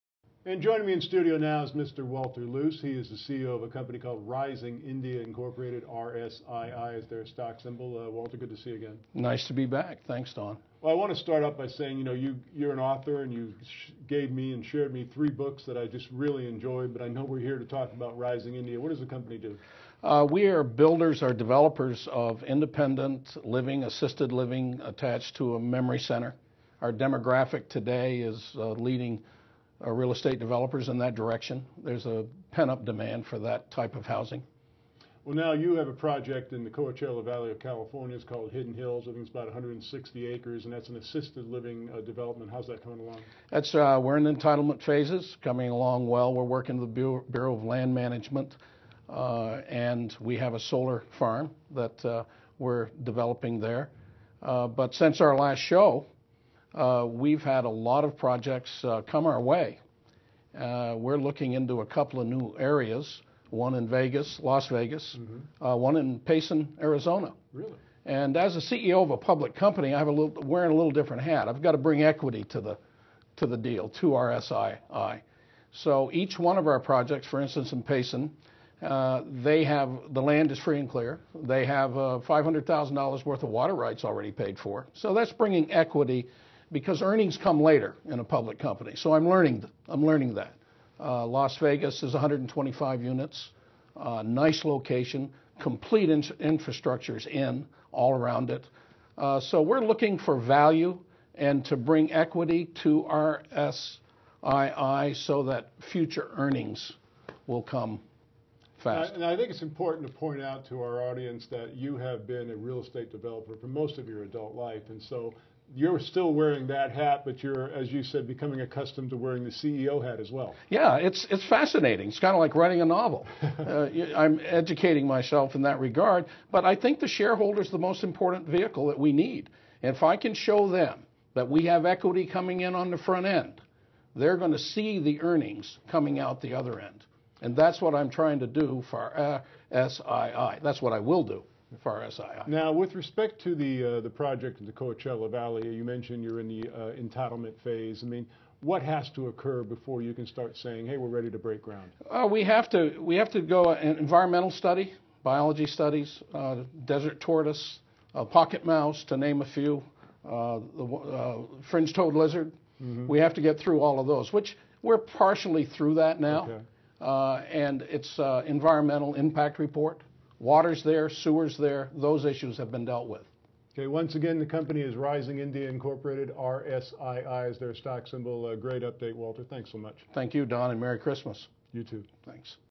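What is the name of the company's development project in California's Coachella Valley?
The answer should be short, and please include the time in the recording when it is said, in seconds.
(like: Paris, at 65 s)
Hidden Hills, at 38 s.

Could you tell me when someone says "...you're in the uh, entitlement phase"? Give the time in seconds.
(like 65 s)
146 s.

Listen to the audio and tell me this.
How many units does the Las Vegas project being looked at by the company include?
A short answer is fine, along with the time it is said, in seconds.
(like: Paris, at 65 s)
125, at 92 s.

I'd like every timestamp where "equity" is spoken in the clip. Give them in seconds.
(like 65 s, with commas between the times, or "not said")
72 s, 85 s, 102 s, 131 s.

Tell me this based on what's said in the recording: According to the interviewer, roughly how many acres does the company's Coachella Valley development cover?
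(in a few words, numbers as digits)
160 acres.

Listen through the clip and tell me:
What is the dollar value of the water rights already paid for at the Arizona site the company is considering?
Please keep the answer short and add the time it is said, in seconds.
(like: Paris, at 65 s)
$500,000, at 82 s.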